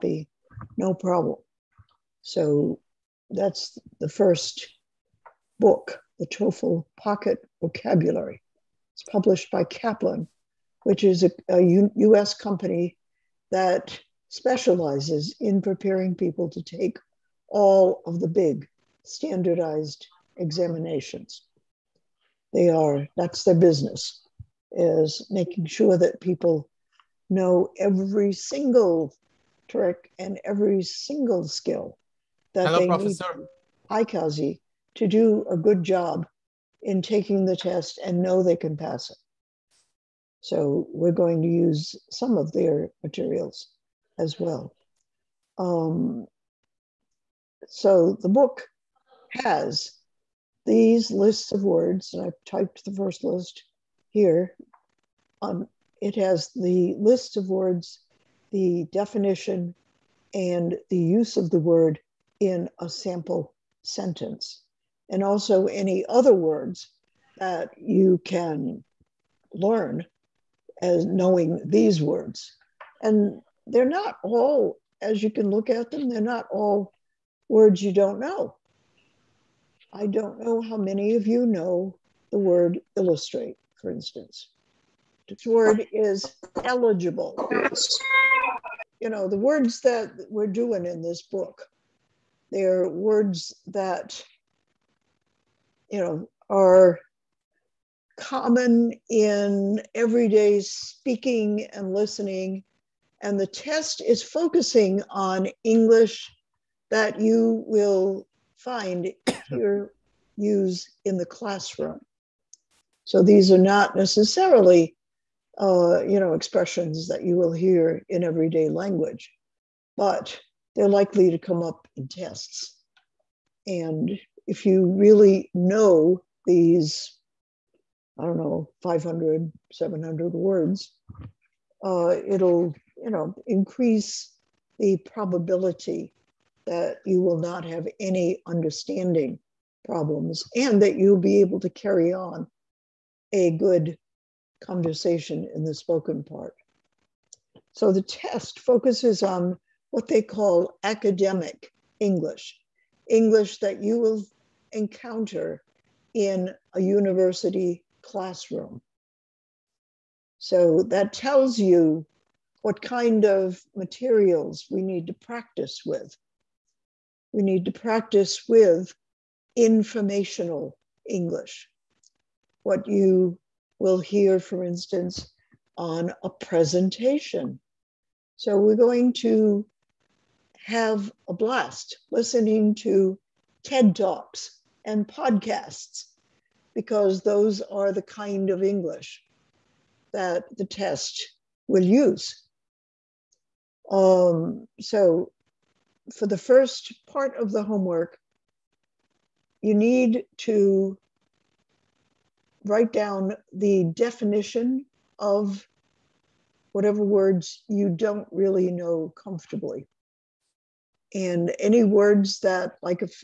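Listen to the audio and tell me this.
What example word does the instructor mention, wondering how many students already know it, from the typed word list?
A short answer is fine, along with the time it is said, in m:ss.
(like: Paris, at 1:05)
illustrate, at 1:22.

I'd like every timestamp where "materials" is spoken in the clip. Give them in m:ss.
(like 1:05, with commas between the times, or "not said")
0:43, 2:43.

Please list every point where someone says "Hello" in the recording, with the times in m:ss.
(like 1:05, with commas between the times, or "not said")
0:32.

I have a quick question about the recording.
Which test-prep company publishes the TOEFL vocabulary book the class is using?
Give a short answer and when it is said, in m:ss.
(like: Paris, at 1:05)
Kaplan, at 0:09.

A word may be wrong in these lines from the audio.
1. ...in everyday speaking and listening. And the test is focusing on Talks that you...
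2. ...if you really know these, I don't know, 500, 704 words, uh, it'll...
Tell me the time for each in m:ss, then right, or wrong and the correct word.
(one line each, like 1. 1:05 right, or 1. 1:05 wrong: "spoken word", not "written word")
1. 1:39 wrong: "English", not "Talks"
2. 2:04 wrong: "700", not "704".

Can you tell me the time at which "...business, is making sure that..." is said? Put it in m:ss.
0:23.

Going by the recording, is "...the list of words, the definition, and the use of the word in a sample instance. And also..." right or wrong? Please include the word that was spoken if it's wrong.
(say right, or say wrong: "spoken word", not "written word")
wrong: "sentence", not "instance".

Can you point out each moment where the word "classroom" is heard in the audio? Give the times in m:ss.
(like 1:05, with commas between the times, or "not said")
1:51, 2:38.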